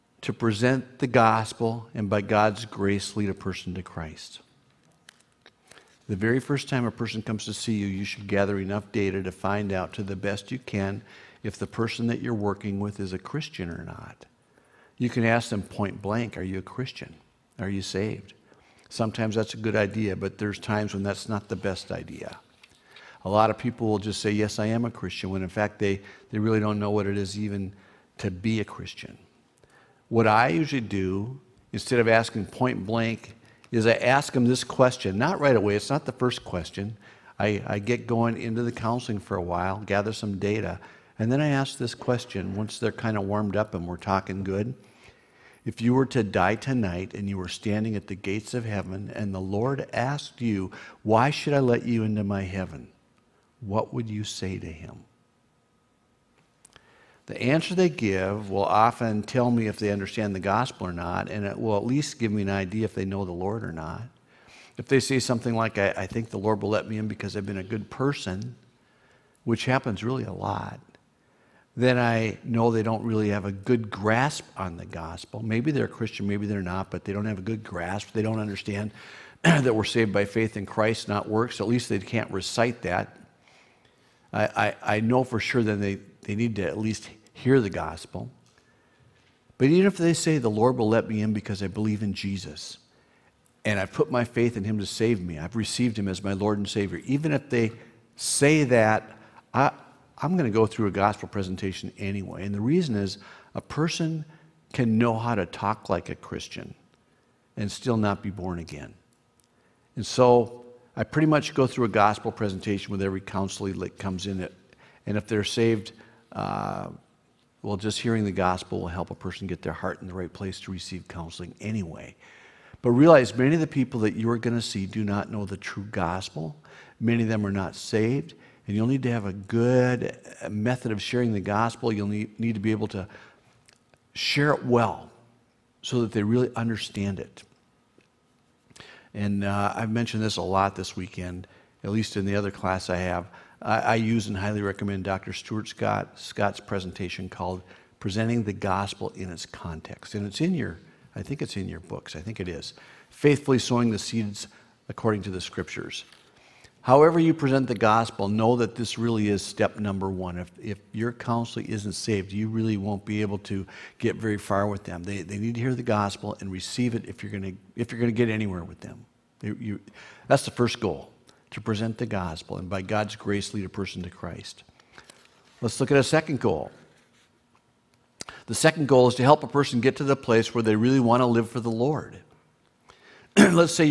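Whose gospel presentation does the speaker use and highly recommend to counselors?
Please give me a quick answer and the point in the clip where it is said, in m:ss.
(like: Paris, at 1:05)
Dr. Stuart Scott, at 2:25.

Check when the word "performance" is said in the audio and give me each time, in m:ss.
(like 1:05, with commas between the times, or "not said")
not said.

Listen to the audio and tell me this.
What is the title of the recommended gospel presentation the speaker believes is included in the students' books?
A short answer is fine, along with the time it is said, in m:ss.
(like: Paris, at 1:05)
Presenting the Gospel in Its Context, at 2:27.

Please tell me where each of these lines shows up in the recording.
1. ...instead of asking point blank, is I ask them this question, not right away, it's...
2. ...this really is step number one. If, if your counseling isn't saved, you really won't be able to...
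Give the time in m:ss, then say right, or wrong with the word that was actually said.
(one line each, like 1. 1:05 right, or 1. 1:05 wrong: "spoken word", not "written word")
1. 0:31 right
2. 2:38 right.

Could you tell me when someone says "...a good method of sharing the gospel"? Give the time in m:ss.
2:09.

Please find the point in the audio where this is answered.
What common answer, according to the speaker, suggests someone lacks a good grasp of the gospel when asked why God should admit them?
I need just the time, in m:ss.
1:07.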